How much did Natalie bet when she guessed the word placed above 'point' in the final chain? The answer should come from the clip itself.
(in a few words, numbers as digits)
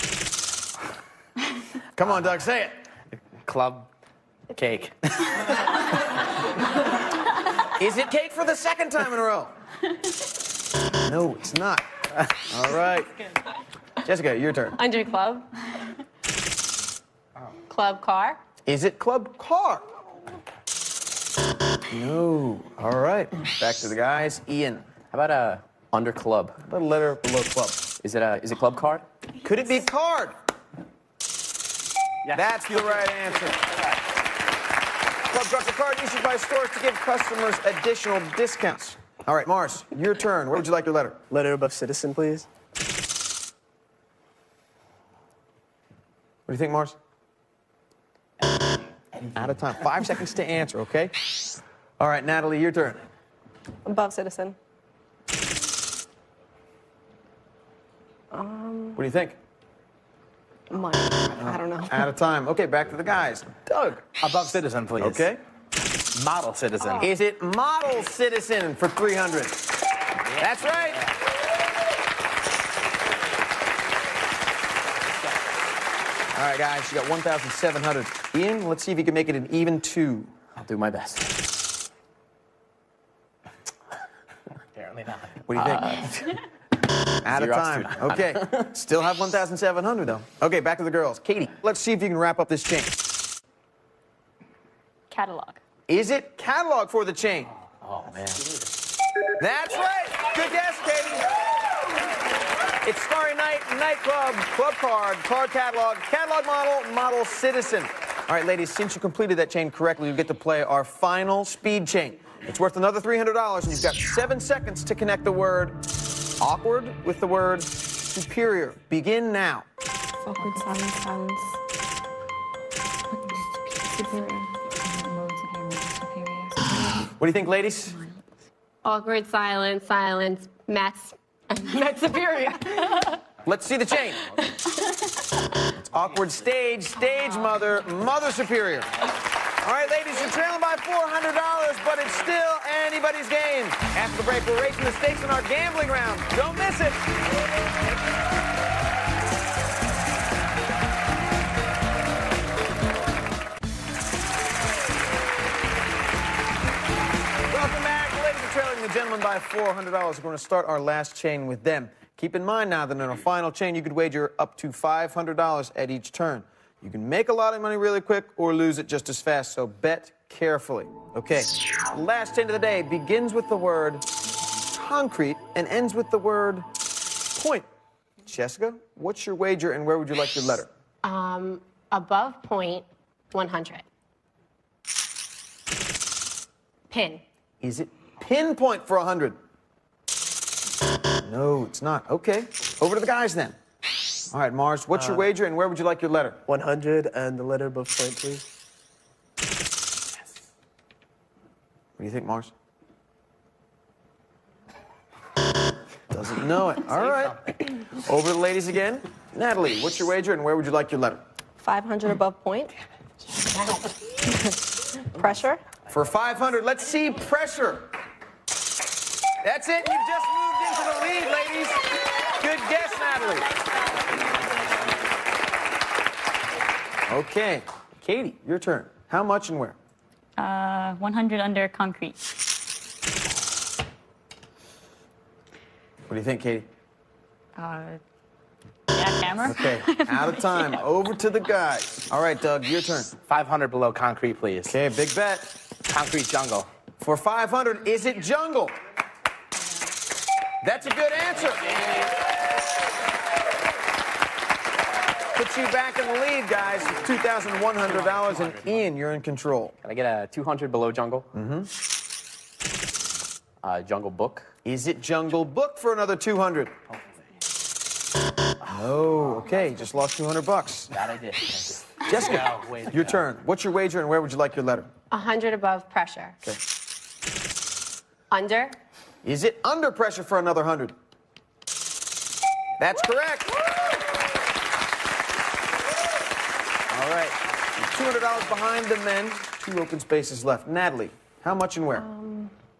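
500.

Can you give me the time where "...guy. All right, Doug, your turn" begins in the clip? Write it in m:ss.
4:01.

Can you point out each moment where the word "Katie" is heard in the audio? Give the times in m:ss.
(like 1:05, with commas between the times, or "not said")
1:31, 1:40, 3:48, 3:56.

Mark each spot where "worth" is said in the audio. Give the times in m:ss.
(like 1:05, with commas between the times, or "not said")
1:52.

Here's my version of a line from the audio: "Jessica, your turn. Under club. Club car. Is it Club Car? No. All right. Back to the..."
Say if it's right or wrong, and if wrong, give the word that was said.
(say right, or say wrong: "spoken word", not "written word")
right.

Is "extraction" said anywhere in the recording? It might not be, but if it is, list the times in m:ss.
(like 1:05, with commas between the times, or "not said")
not said.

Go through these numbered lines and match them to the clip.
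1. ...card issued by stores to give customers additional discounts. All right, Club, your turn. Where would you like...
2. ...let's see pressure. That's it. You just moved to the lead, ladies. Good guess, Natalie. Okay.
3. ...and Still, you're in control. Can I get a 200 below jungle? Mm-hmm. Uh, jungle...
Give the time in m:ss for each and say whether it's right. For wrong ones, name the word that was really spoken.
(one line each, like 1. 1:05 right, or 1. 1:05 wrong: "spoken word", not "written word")
1. 0:35 wrong: "Mars", not "Club"
2. 3:36 right
3. 4:18 wrong: "Ian", not "Still".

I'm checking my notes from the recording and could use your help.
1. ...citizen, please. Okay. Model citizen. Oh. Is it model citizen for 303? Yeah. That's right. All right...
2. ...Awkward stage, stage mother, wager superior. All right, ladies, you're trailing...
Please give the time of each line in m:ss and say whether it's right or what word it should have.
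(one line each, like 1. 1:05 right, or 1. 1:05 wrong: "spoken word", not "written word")
1. 1:04 wrong: "300", not "303"
2. 2:15 wrong: "mother", not "wager".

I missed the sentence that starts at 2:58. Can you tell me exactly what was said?
Jessica, what's your wager and where would you like your letter?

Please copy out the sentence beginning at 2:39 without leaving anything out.
We're going to start our last chain with them.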